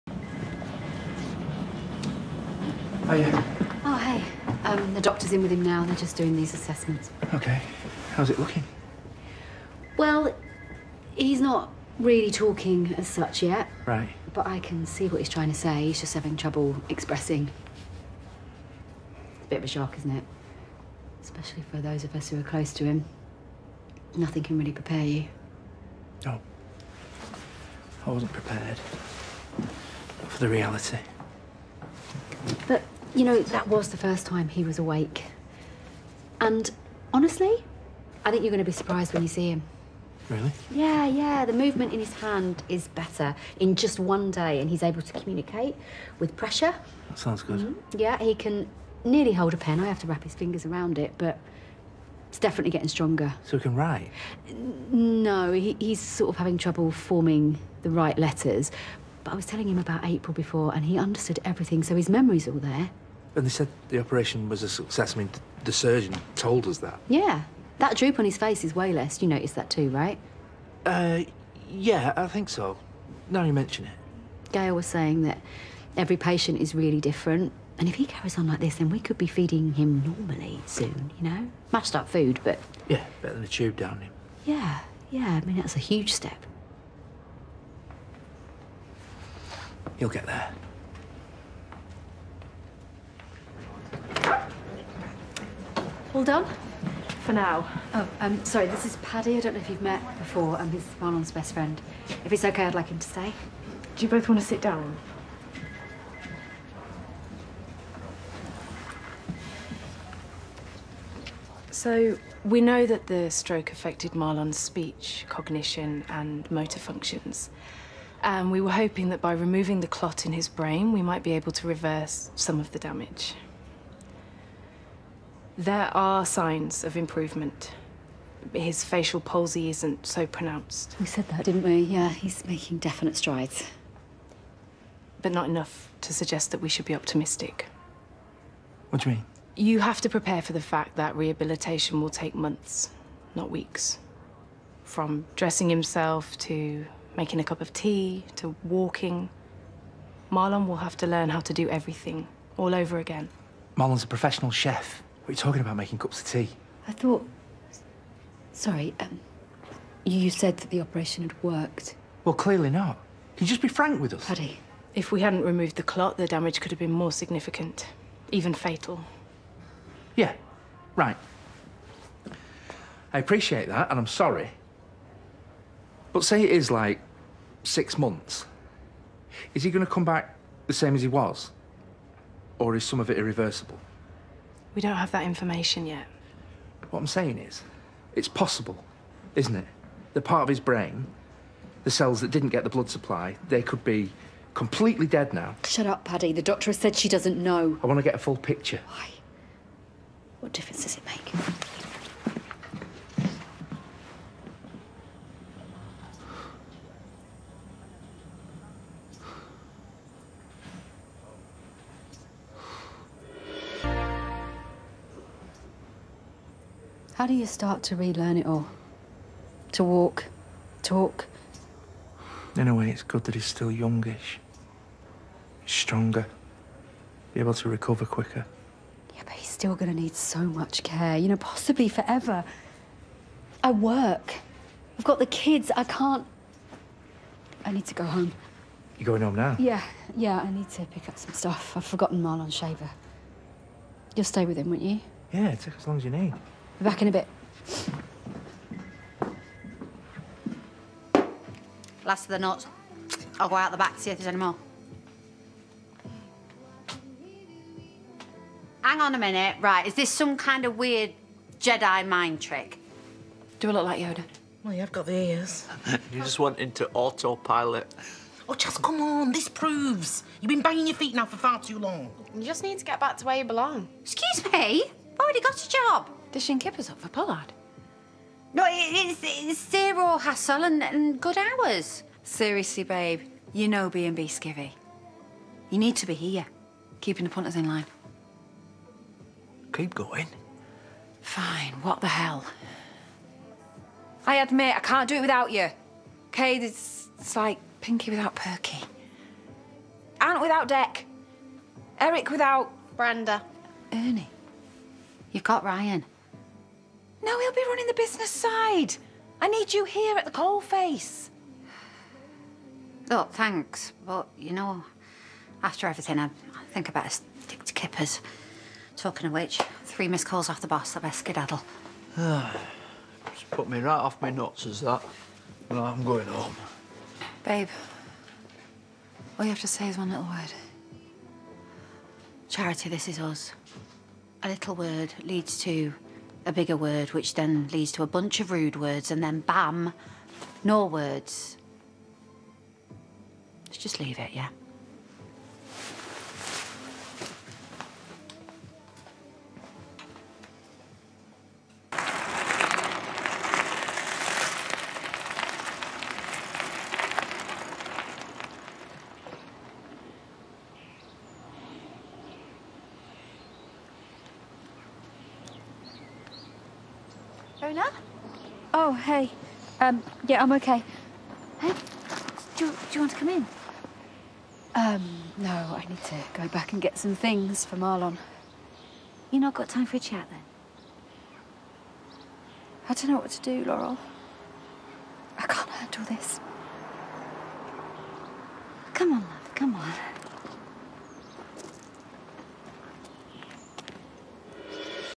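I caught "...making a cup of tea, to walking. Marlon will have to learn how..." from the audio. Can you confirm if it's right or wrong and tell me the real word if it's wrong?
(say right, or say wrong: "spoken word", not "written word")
right.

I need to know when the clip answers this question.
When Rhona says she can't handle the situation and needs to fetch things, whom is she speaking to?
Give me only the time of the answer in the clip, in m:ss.
6:23.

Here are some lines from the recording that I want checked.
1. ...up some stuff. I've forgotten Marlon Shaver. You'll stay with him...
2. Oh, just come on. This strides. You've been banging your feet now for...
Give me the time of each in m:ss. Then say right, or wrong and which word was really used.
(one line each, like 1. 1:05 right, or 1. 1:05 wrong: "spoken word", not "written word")
1. 4:01 right
2. 4:28 wrong: "proves", not "strides".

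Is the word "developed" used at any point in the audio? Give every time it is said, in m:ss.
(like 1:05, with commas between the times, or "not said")
not said.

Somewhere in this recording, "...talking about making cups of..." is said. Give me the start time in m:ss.
2:35.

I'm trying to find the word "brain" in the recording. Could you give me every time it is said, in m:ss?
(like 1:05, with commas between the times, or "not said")
2:00, 3:10.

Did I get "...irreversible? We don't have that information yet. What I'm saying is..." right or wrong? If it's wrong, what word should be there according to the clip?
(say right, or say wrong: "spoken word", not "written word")
right.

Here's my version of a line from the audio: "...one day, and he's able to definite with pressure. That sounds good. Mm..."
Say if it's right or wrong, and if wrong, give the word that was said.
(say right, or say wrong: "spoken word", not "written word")
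wrong: "communicate", not "definite".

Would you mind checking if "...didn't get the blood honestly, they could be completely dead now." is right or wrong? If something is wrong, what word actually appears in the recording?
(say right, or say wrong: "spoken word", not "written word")
wrong: "supply", not "honestly".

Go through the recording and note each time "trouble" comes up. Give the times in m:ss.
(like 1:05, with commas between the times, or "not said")
0:16, 0:56.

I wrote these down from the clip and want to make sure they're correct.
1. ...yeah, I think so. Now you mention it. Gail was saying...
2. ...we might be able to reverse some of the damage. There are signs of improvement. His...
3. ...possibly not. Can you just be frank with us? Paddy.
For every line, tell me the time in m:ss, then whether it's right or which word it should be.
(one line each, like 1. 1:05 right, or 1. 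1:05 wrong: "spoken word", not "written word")
1. 1:11 right
2. 2:00 right
3. 2:42 wrong: "clearly", not "possibly".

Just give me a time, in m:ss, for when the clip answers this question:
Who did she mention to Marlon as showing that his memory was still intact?
1:00.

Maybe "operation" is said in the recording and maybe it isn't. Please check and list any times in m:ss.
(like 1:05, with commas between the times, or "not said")
1:03, 2:40.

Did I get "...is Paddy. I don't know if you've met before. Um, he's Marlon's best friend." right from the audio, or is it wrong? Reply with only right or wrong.
right.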